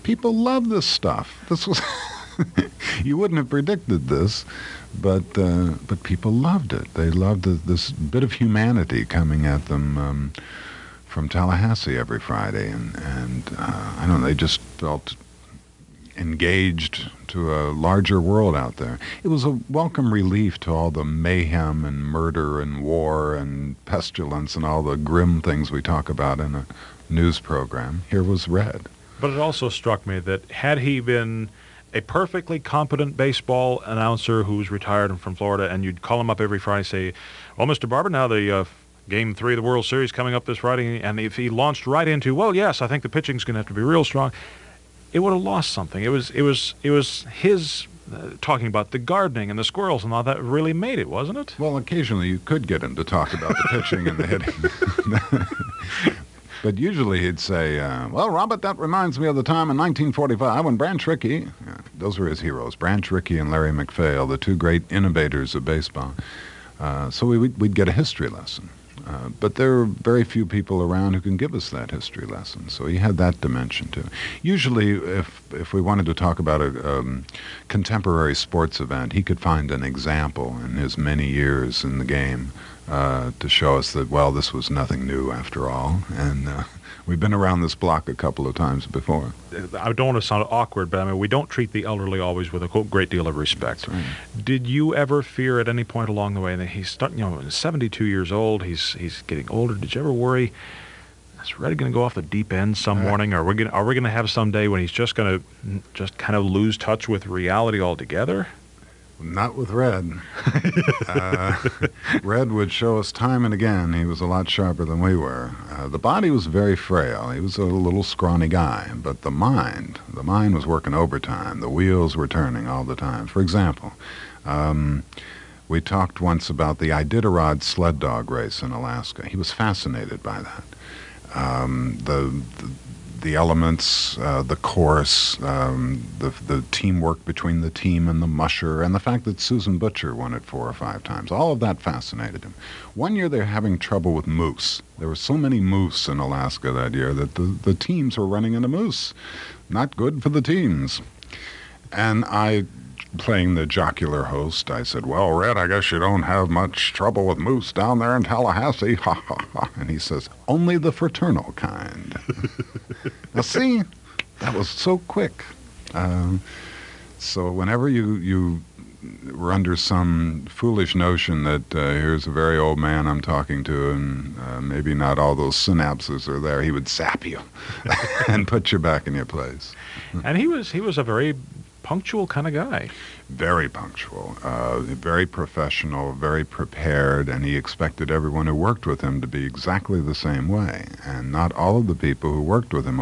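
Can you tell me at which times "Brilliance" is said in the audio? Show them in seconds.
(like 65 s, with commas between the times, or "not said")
not said.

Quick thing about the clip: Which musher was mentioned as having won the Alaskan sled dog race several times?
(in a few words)
Susan Butcher.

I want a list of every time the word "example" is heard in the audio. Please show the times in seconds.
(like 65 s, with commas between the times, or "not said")
79 s, 123 s.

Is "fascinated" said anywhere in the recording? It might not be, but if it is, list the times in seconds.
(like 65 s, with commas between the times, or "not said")
129 s, 141 s.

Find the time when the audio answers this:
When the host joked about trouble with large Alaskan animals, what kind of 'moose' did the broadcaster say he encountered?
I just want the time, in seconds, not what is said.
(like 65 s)
160 s.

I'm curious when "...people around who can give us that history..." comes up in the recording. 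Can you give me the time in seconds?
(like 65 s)
70 s.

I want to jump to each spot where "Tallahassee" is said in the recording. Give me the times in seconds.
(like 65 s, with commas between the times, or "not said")
11 s, 158 s.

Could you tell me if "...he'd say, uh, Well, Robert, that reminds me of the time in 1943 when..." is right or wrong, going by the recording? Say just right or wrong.
wrong.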